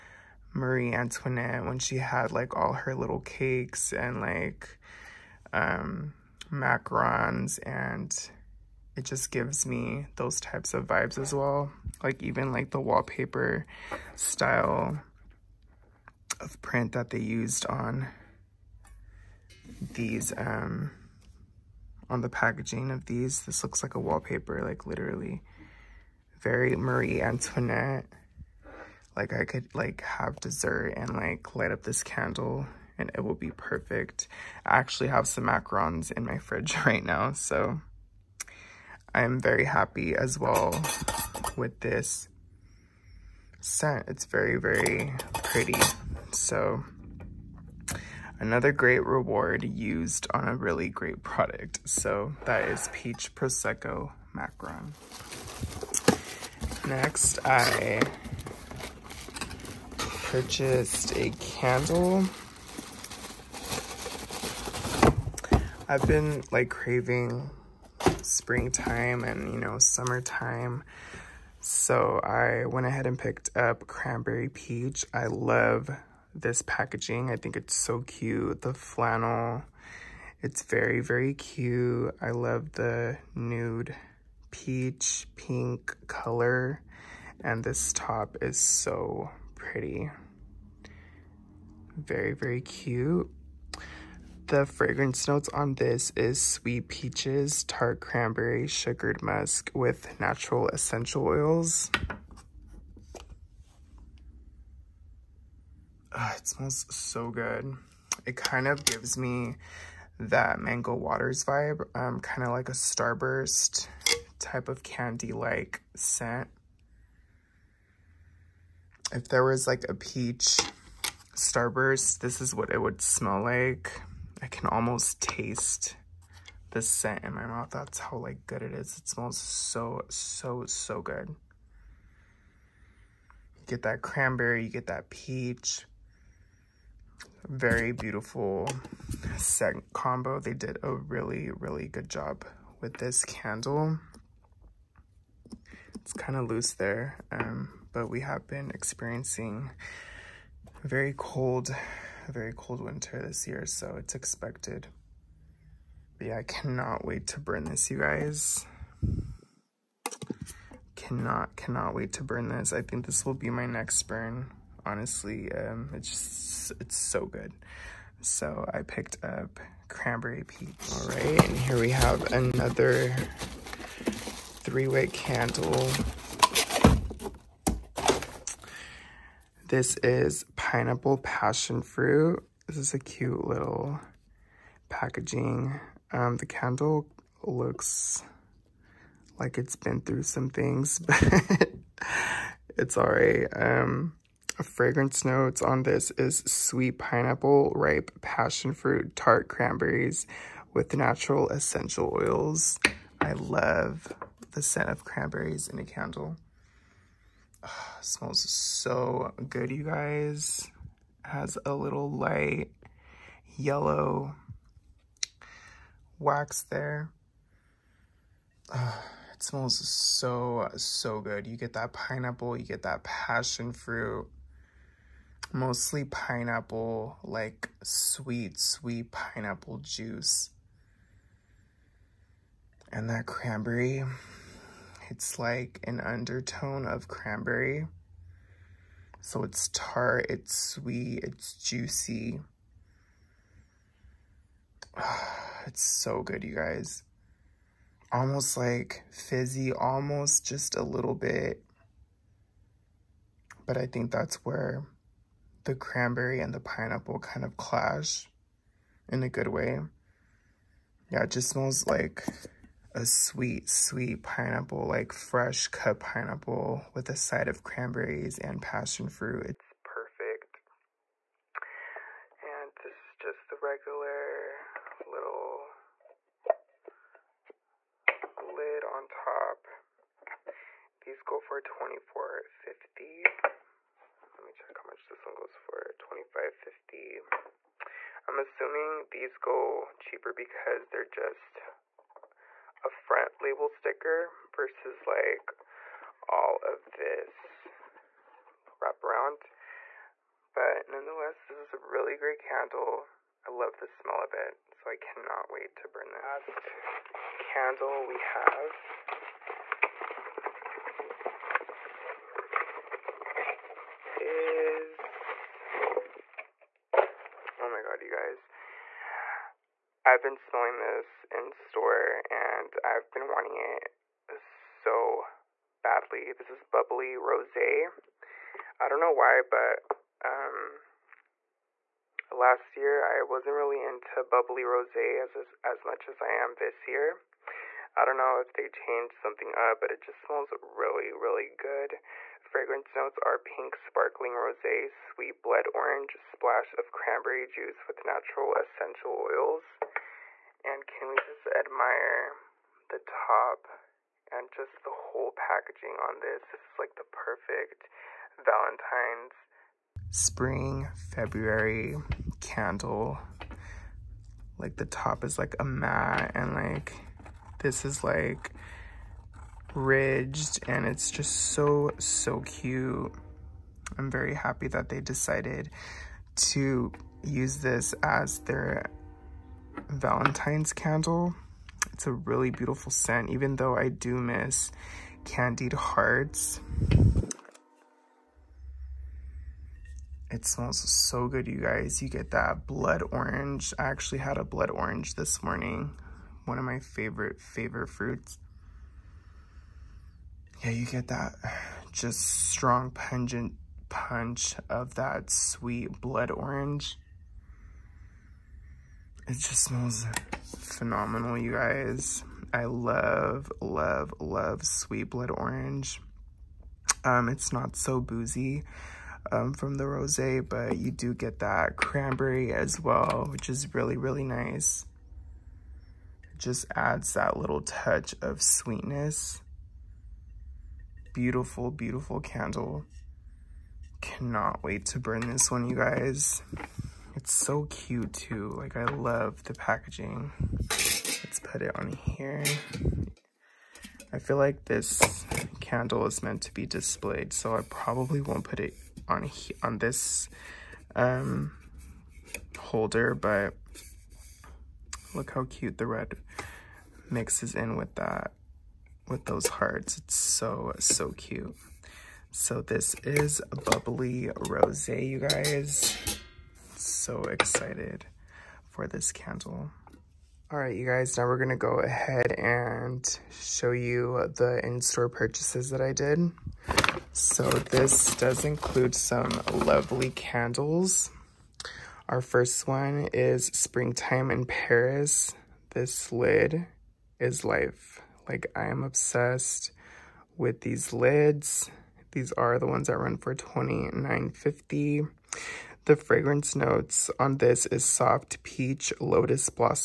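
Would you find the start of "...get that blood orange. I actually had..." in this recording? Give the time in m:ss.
6:32.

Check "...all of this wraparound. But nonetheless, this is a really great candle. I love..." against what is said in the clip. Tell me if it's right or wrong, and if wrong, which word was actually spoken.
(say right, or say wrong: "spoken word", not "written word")
right.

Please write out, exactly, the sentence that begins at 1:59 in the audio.
If there was like a peach starburst, this is what it would smell like.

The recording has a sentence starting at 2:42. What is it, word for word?
I think this will be my next burn, honestly.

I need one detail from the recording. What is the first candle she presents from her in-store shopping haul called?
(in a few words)
Springtime in Paris.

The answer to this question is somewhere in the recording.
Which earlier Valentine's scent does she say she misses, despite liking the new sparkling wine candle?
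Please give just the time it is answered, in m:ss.
6:25.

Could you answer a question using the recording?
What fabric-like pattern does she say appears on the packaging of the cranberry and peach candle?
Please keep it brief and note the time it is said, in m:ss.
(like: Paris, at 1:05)
Flannel, at 1:18.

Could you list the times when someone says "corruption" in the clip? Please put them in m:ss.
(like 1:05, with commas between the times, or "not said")
not said.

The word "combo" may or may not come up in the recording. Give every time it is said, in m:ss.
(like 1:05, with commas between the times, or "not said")
2:19.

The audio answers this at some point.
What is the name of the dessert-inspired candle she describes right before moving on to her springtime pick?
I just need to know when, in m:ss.
0:52.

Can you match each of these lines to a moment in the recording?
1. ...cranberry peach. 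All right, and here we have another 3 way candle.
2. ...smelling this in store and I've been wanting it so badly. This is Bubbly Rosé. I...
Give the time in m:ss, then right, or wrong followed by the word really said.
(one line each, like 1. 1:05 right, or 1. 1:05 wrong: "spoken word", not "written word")
1. 2:49 right
2. 5:20 right.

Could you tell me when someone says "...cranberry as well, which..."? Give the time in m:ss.
7:01.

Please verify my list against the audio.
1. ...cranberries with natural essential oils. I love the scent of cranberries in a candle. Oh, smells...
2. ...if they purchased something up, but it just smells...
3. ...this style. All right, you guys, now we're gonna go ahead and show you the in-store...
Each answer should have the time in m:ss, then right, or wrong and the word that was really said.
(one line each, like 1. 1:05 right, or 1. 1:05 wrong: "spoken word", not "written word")
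1. 3:19 right
2. 5:38 wrong: "changed", not "purchased"
3. 7:48 wrong: "candle", not "style".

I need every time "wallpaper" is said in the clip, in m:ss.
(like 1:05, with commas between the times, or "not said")
0:12, 0:24.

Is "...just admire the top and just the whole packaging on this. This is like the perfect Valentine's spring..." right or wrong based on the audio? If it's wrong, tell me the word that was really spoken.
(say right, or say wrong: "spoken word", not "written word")
right.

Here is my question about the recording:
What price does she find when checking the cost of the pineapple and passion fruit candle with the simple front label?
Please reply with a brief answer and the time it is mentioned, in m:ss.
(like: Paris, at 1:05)
$25.50, at 4:45.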